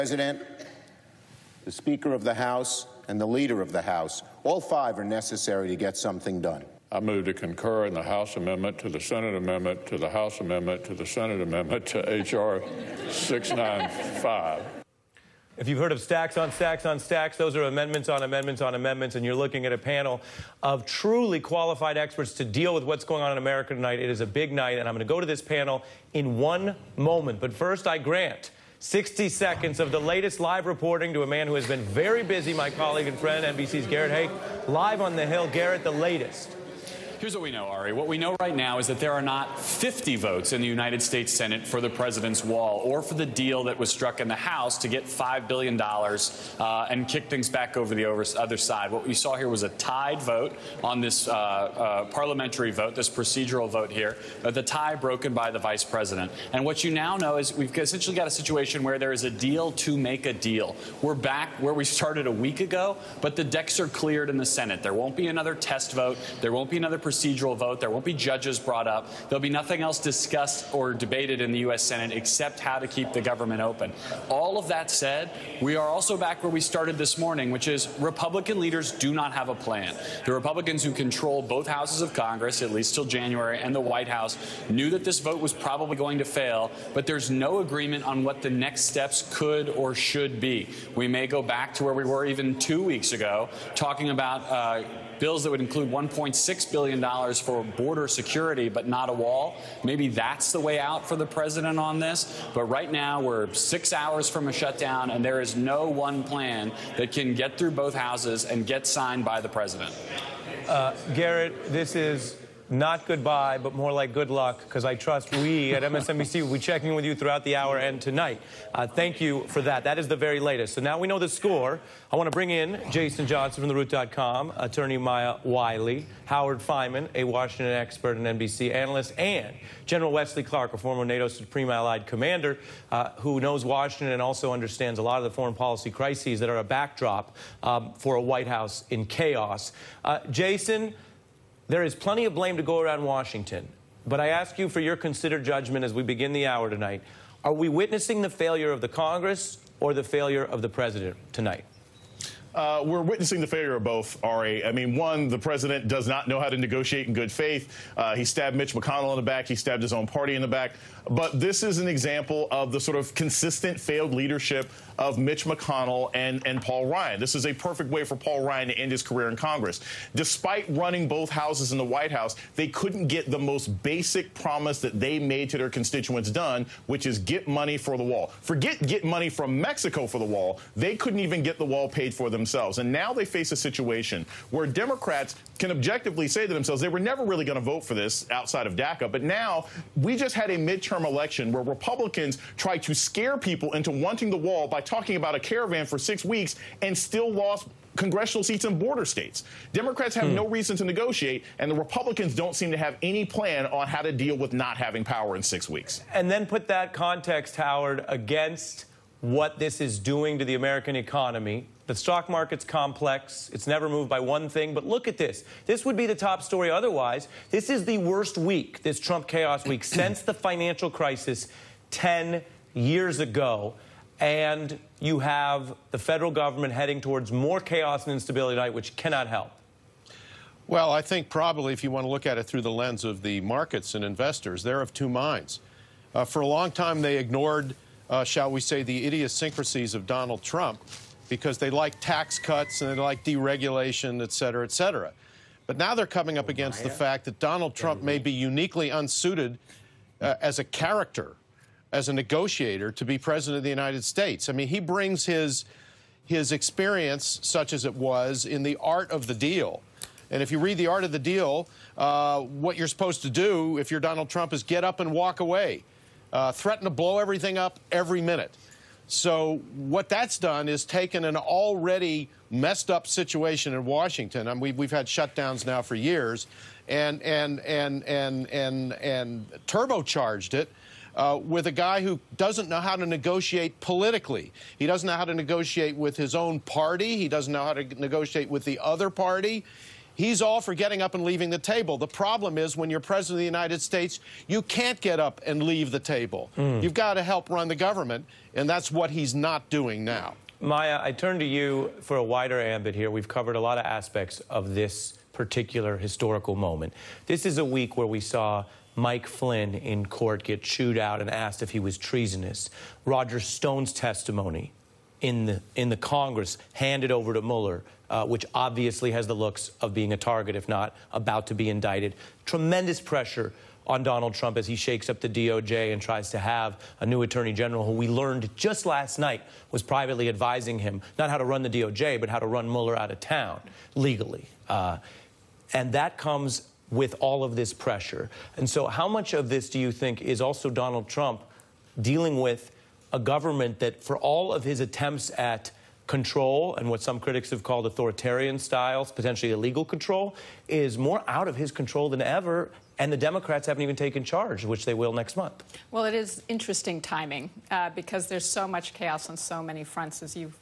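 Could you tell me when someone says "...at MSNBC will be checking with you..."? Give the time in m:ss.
1:55.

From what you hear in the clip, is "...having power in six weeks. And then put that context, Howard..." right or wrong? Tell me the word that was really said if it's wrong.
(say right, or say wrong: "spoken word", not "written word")
right.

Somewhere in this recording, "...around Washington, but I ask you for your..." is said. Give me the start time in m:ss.
2:22.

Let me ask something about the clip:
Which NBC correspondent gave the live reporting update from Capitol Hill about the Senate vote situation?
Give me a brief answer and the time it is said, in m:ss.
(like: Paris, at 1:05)
Garrett Haake, at 0:33.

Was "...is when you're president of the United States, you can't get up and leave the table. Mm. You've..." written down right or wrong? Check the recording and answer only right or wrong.
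right.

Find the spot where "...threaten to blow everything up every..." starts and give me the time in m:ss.
4:26.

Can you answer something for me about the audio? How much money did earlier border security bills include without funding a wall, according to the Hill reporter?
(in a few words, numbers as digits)
$1.6 billion.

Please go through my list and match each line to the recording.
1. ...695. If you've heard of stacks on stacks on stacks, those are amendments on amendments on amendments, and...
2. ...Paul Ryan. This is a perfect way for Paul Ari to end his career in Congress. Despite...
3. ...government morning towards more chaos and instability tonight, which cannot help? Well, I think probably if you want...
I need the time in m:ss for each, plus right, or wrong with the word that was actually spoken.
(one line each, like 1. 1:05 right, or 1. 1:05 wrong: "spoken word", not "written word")
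1. 0:13 right
2. 2:46 wrong: "Ryan", not "Ari"
3. 3:46 wrong: "heading", not "morning".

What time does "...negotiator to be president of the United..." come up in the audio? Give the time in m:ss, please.
4:12.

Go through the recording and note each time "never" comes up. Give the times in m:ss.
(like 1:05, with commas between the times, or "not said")
3:06, 3:33.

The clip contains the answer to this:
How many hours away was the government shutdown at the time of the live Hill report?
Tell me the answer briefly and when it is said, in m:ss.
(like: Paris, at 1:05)
6, at 1:43.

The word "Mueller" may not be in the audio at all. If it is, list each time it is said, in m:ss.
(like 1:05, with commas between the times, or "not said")
5:17, 5:32.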